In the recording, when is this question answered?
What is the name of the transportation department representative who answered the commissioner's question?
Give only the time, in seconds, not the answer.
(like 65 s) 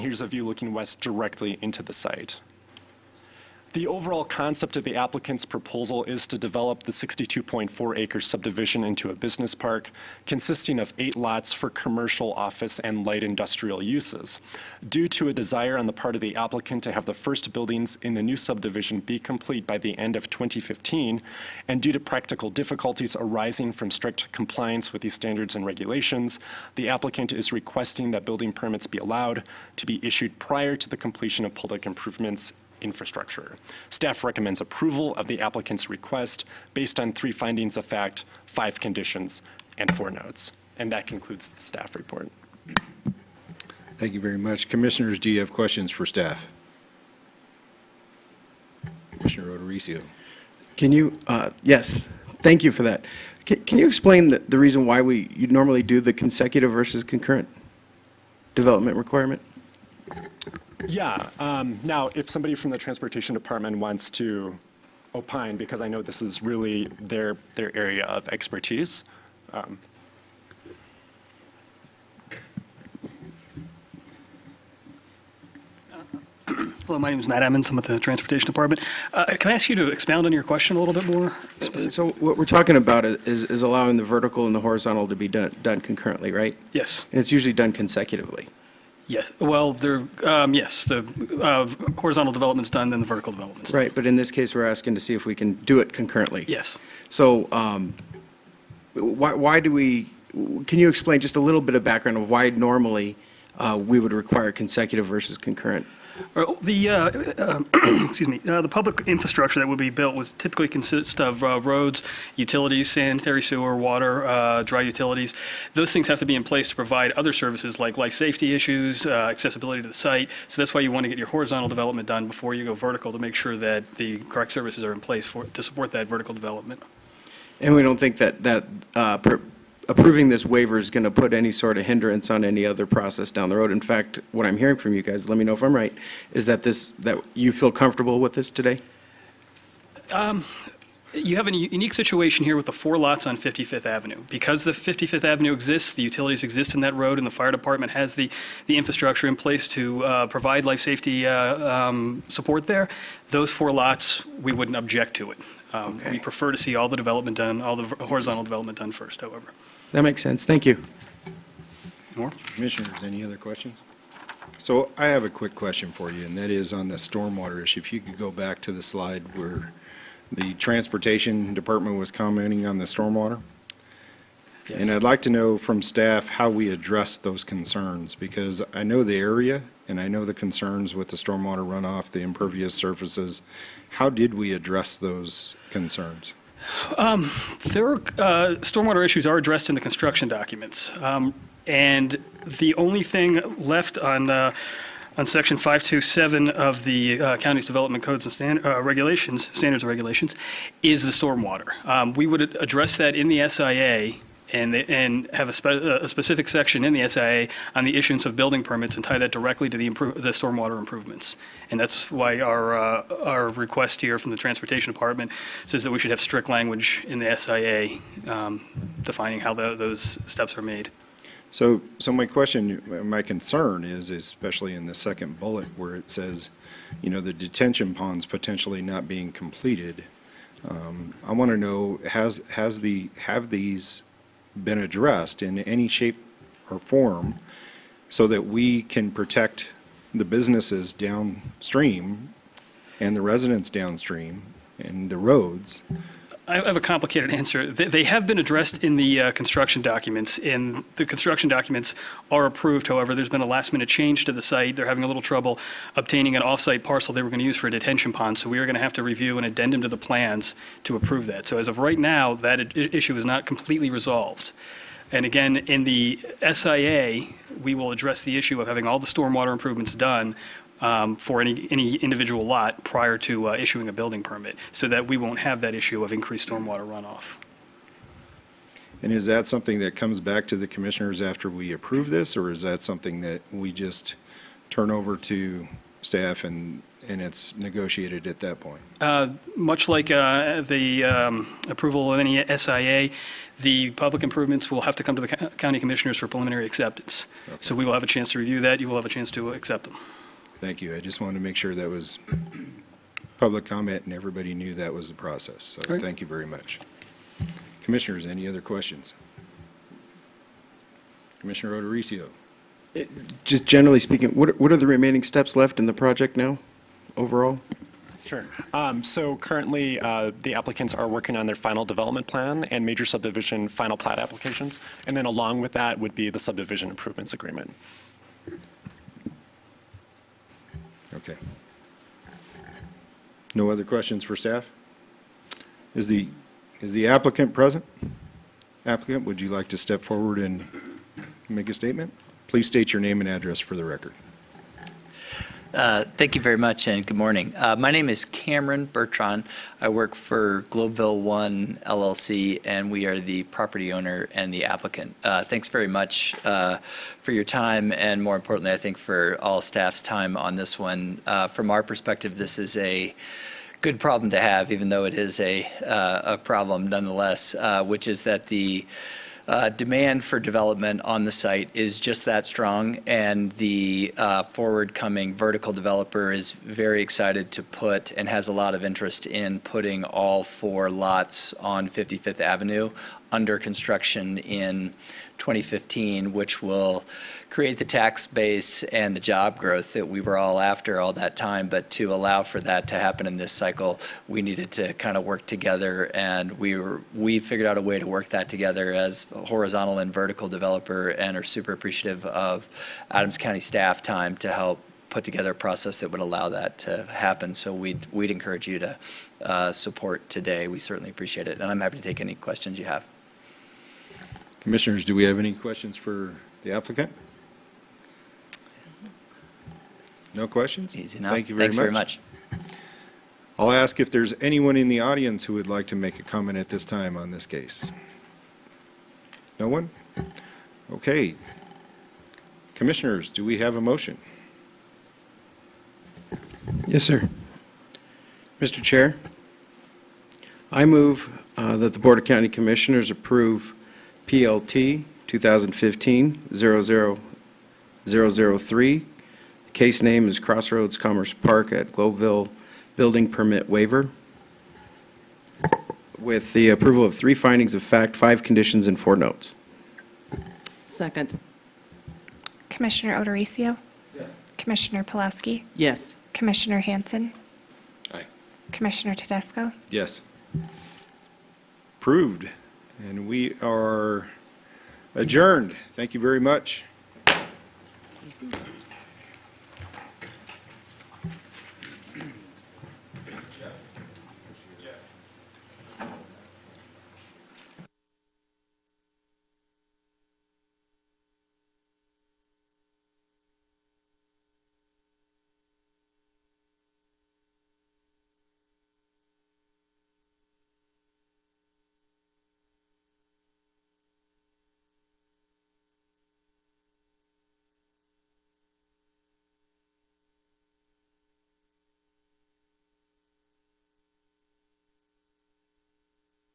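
77 s.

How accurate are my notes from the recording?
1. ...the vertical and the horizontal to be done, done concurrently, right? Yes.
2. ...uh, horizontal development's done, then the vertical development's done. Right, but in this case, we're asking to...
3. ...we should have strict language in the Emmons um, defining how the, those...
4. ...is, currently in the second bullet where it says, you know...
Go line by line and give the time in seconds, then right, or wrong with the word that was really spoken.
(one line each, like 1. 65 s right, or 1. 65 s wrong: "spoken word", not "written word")
1. 83 s right
2. 91 s right
3. 215 s wrong: "SIA", not "Emmons"
4. 223 s wrong: "especially", not "currently".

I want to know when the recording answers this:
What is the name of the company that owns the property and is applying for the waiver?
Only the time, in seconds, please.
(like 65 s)
350 s.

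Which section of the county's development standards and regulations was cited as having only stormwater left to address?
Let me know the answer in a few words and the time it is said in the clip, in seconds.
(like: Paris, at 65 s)
527, at 195 s.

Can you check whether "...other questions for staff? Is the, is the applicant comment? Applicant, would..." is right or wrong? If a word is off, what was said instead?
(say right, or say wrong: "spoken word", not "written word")
wrong: "present", not "comment".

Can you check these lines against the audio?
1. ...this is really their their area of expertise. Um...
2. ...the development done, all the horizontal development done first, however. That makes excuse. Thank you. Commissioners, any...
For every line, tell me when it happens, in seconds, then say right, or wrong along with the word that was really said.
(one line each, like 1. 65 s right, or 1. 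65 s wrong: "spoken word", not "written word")
1. 66 s right
2. 156 s wrong: "sense", not "excuse".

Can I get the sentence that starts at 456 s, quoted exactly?
With the approval of three findings of fact, five conditions, and four notes.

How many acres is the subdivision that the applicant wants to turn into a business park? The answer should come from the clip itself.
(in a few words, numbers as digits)
62.4.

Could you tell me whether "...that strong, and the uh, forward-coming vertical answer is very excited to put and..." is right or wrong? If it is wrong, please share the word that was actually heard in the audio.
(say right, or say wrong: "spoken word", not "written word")
wrong: "developer", not "answer".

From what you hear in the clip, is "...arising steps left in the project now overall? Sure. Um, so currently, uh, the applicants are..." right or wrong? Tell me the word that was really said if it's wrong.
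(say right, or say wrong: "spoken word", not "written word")
wrong: "remaining", not "arising".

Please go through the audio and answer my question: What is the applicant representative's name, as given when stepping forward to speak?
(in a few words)
Cameron Bertron.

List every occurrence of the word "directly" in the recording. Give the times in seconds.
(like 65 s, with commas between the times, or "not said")
1 s, 209 s.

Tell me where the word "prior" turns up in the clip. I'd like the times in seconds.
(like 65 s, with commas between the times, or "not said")
30 s, 272 s.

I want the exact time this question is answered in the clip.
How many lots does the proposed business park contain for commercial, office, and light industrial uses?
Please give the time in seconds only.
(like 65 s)
10 s.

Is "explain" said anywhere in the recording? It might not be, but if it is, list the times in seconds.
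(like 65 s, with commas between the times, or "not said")
53 s, 100 s.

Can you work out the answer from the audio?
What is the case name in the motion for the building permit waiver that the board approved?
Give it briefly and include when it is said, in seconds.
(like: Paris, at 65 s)
Crossroads Commerce Park at Globeville, at 450 s.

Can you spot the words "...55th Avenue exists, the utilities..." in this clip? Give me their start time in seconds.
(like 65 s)
144 s.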